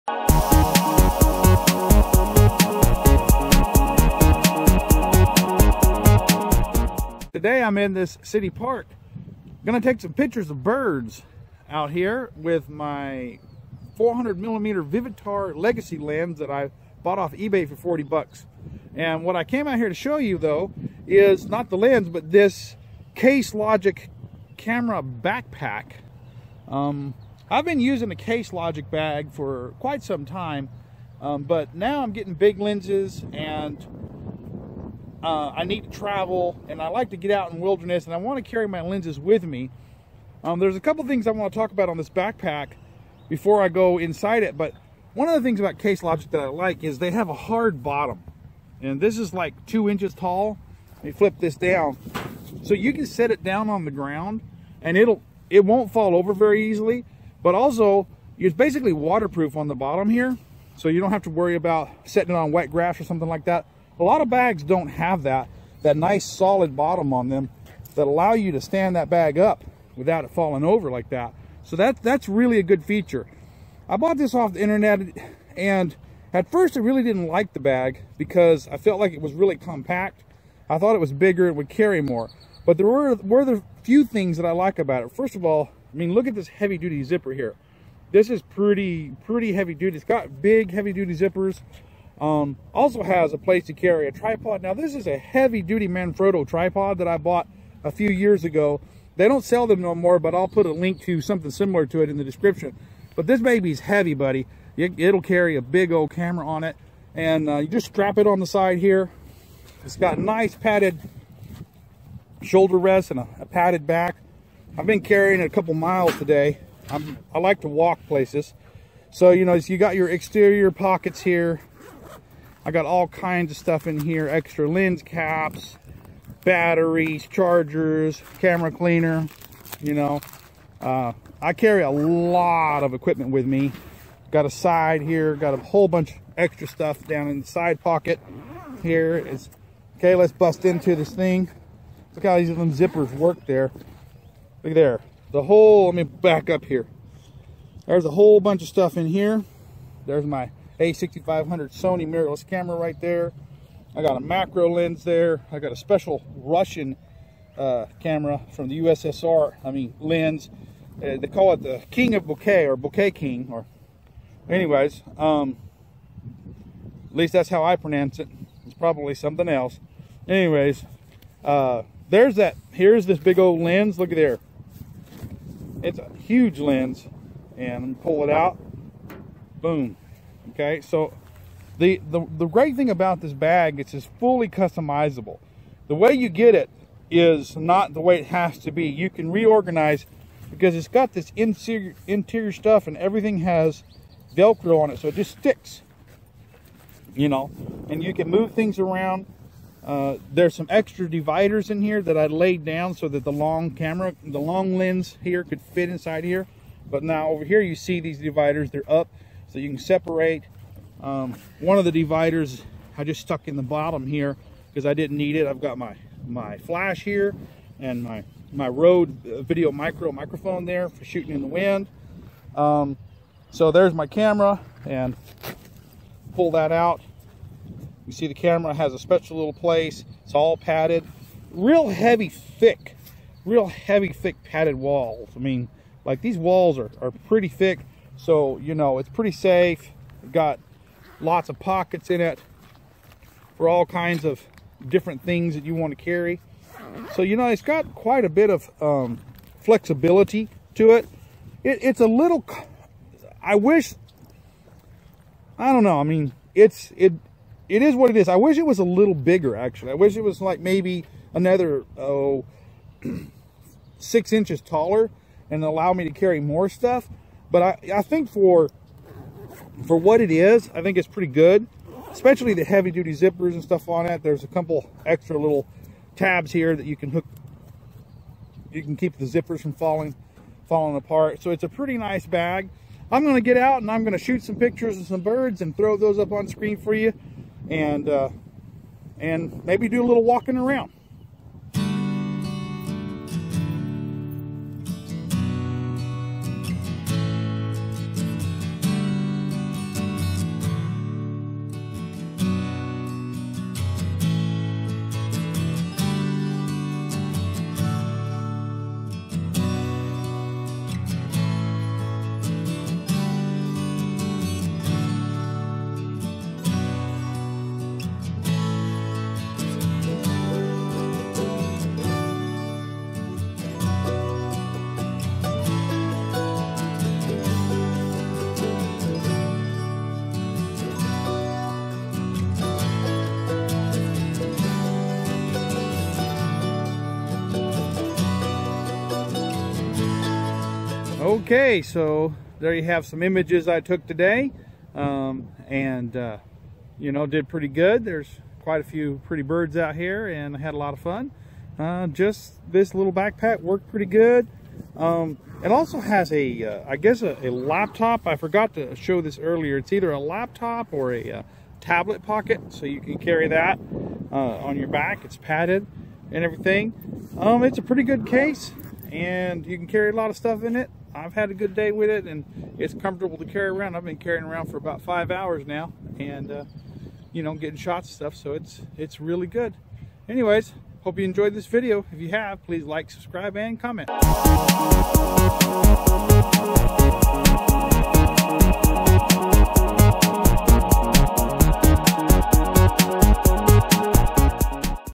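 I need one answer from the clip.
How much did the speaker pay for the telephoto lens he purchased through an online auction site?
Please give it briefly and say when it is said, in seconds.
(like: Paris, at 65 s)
$40, at 17 s.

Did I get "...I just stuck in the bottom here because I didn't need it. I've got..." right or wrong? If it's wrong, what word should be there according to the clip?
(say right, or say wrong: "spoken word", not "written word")
right.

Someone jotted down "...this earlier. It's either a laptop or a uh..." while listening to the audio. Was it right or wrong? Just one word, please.
right.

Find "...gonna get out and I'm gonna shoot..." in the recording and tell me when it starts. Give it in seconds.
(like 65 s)
283 s.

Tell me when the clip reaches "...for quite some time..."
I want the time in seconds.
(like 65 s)
29 s.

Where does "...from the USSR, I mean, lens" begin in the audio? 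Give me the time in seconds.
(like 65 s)
158 s.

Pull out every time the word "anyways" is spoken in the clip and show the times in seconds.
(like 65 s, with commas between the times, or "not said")
164 s, 170 s, 380 s.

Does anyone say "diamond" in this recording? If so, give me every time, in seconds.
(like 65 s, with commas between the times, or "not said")
not said.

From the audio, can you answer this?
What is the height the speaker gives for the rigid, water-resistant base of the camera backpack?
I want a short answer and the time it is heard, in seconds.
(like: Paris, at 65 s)
2 inches, at 49 s.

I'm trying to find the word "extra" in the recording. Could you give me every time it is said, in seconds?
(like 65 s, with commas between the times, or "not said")
124 s, 136 s, 200 s, 275 s.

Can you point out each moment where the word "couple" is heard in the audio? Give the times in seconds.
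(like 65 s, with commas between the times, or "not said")
40 s, 115 s, 274 s.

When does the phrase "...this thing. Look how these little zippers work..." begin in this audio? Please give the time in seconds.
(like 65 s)
140 s.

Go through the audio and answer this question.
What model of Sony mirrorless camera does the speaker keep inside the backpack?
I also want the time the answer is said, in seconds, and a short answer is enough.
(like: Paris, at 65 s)
a6500, at 150 s.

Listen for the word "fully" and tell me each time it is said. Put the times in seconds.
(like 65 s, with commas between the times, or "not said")
184 s.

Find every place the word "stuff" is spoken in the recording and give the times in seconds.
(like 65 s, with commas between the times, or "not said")
123 s, 136 s, 148 s, 192 s, 266 s, 273 s, 370 s, 378 s.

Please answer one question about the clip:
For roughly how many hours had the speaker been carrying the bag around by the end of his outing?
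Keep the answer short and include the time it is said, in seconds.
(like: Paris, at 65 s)
5 hours, at 375 s.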